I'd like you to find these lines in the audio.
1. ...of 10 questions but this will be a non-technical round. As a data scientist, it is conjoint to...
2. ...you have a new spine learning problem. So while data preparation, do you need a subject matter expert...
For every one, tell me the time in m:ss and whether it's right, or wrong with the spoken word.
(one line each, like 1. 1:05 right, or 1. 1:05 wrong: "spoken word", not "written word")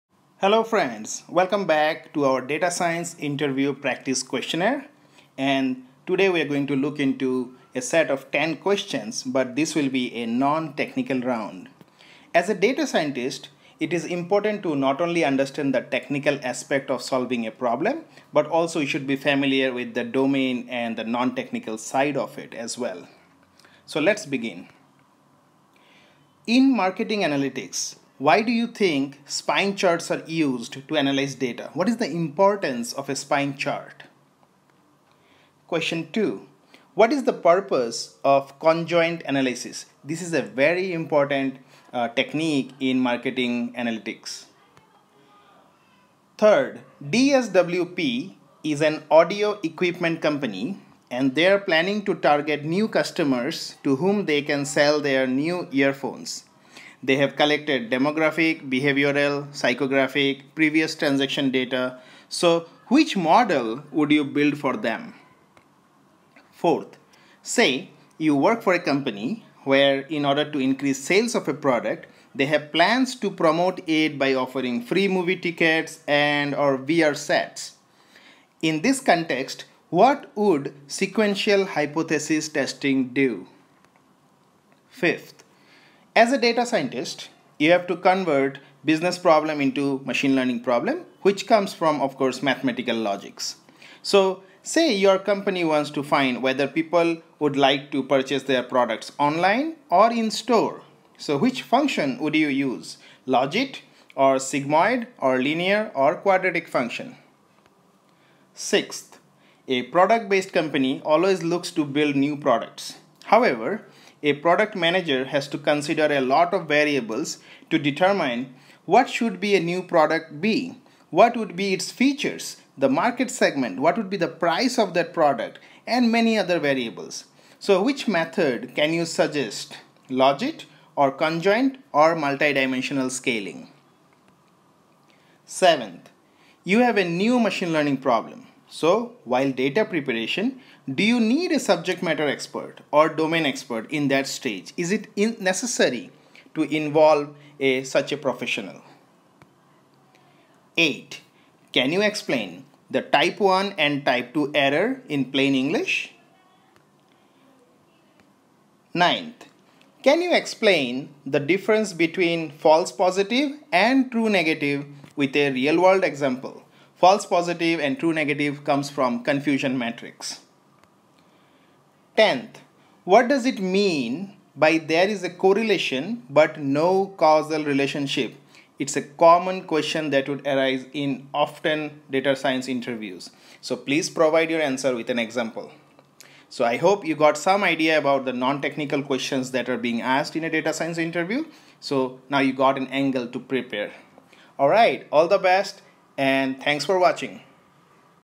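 1. 0:08 wrong: "important", not "conjoint"
2. 2:16 wrong: "machine", not "spine".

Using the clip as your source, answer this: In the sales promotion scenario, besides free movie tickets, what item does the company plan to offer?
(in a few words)
VR sets.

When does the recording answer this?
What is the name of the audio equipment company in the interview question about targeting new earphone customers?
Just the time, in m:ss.
0:47.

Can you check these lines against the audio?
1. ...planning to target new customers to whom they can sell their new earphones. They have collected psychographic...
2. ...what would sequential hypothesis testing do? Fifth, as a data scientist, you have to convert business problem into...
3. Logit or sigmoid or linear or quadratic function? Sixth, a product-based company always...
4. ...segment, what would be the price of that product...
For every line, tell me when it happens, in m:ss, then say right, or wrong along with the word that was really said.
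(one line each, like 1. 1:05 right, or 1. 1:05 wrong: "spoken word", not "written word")
1. 0:51 wrong: "demographic", not "psychographic"
2. 1:19 right
3. 1:43 right
4. 2:03 right.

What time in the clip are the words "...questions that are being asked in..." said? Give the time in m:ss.
3:09.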